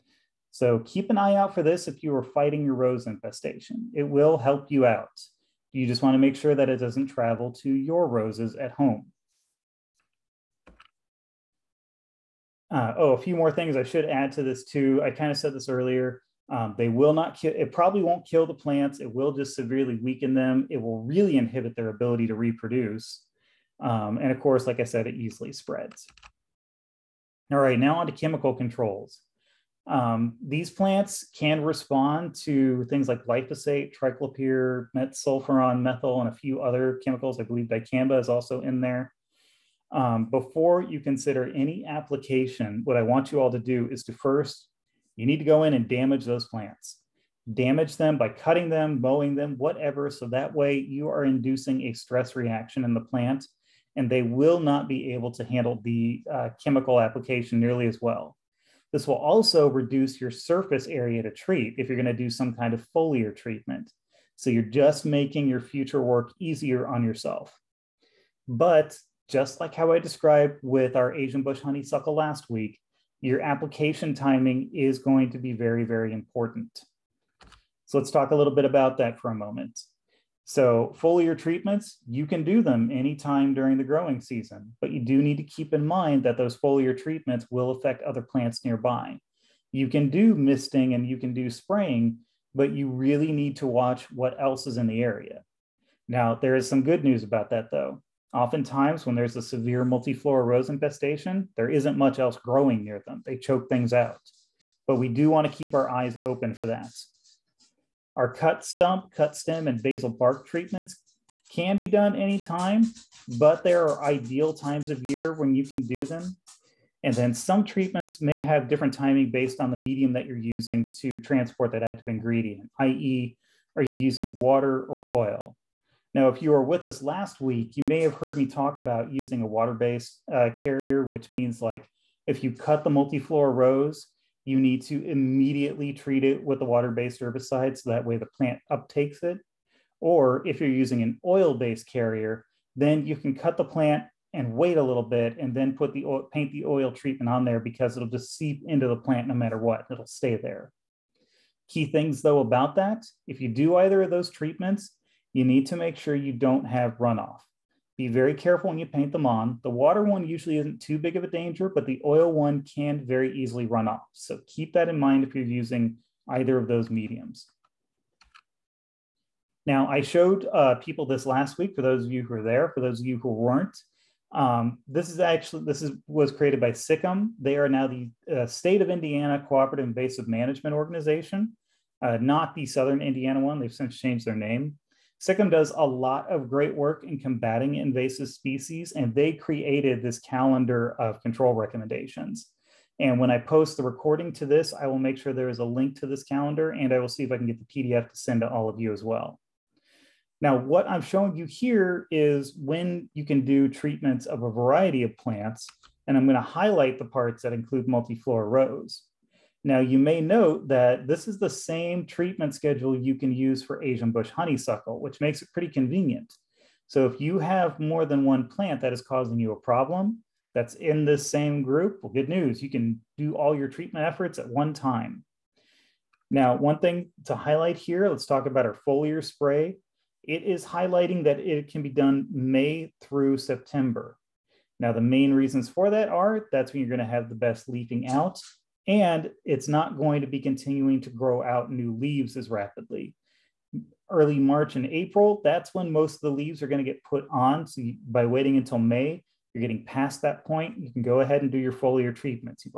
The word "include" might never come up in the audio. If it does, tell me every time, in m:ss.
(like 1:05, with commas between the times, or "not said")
3:27.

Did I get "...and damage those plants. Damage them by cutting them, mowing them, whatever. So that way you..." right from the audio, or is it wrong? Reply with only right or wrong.
right.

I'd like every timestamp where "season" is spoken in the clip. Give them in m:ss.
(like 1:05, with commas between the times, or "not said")
1:24.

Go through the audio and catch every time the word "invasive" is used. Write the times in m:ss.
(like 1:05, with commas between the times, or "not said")
2:59, 3:07.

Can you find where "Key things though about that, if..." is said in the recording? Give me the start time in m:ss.
2:31.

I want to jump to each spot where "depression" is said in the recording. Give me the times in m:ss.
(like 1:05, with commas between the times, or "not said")
not said.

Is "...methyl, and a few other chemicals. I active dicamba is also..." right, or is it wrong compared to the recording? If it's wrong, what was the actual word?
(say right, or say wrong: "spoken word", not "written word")
wrong: "believe", not "active".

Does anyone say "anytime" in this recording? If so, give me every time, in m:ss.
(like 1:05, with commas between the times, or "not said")
1:22, 1:52.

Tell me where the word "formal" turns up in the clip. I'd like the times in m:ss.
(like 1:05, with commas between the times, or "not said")
not said.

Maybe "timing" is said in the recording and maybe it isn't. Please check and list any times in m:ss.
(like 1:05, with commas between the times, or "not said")
1:14, 1:58.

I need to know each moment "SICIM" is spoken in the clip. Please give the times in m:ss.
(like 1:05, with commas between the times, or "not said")
2:56, 3:05.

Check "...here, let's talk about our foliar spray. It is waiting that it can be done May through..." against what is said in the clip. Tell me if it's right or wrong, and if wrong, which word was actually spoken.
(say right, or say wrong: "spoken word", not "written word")
wrong: "highlighting", not "waiting".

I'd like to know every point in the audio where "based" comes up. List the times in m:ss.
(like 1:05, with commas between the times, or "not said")
1:59, 2:09, 2:16, 2:21.